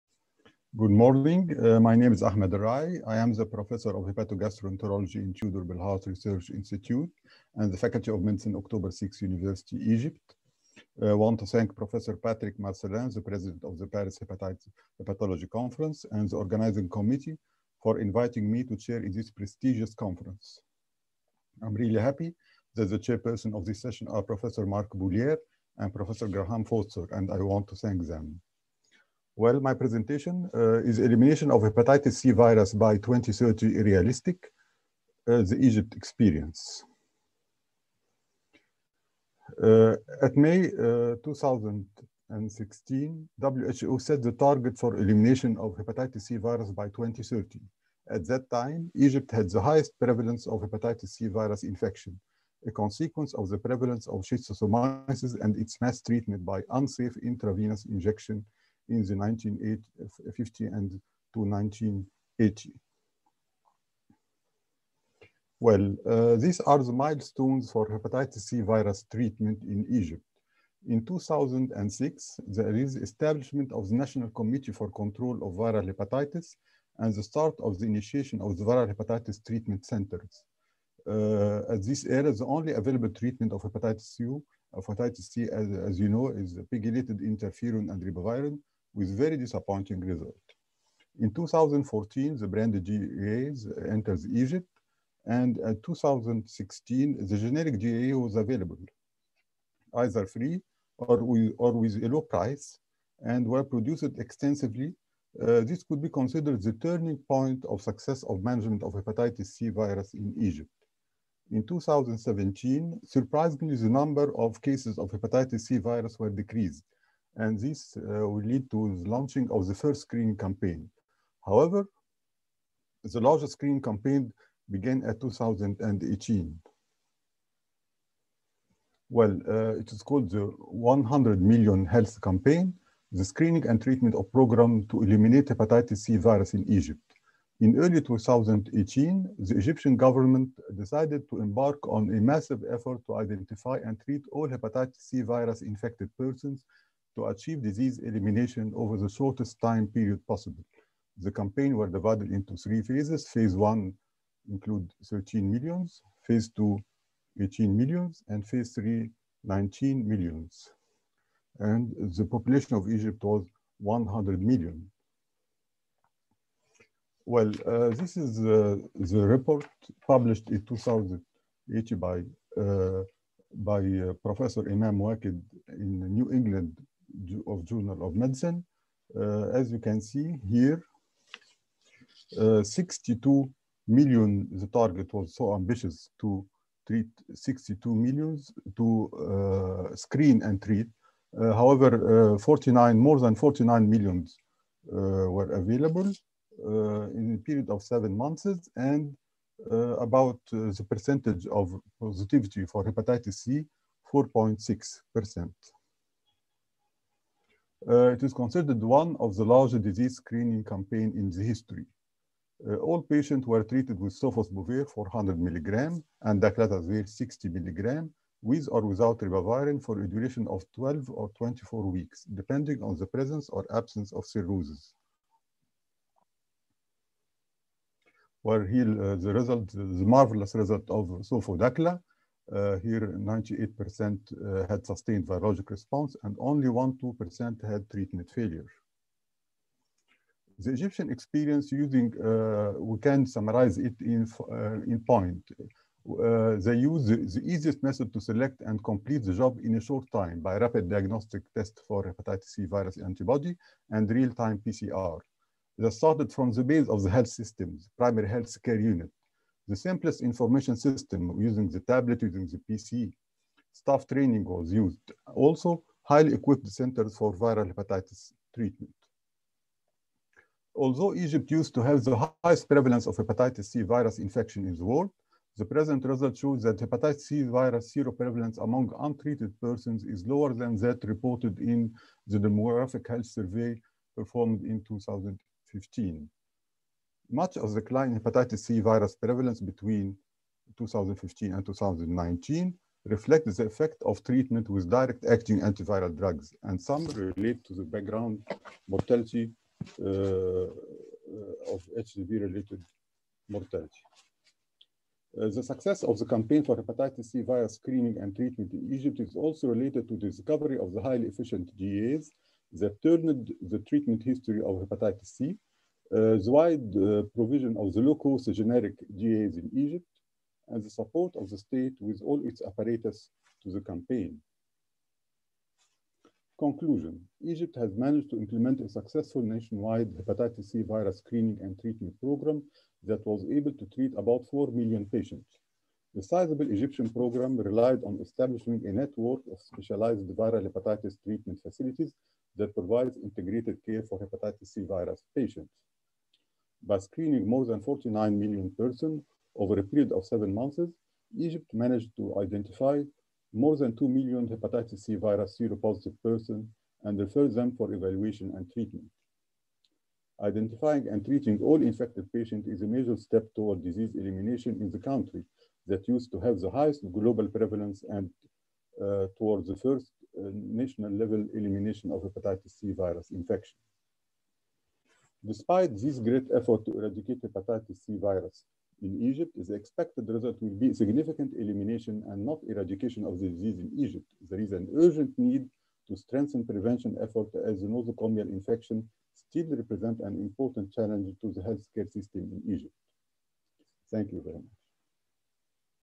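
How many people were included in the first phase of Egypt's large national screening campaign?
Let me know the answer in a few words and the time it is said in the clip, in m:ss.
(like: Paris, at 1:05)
13 million, at 2:35.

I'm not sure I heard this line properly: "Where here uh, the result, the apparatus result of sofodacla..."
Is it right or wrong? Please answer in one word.
wrong.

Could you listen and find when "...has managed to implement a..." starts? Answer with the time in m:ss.
5:27.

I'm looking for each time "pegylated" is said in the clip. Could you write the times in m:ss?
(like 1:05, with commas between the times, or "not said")
1:26.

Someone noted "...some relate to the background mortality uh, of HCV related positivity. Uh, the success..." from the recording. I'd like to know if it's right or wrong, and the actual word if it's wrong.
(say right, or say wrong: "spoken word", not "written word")
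wrong: "mortality", not "positivity".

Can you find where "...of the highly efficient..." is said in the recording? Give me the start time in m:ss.
5:10.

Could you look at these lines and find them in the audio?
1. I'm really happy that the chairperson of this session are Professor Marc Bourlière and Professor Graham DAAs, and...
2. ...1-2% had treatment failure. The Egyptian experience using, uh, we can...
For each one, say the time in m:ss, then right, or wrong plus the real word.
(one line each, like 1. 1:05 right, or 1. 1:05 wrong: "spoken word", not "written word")
1. 0:21 wrong: "Foster", not "DAAs"
2. 3:56 right.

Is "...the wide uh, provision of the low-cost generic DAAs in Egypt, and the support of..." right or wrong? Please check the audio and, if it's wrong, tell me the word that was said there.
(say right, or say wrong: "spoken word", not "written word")
right.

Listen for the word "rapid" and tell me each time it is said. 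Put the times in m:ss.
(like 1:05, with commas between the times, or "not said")
4:10.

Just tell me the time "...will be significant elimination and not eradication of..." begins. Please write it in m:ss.
6:20.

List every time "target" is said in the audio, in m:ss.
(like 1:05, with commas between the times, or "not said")
0:44, 3:04.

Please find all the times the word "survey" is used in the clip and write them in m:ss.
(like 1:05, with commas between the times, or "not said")
4:43.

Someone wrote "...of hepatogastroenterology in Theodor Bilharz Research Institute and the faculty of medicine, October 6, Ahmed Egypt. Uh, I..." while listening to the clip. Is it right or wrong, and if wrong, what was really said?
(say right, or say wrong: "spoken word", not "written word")
wrong: "University", not "Ahmed".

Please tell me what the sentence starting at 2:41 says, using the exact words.
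And the population of Egypt was 100 million.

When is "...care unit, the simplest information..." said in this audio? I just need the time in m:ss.
4:18.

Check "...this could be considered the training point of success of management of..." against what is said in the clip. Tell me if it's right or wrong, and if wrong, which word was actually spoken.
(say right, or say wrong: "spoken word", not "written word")
wrong: "turning", not "training".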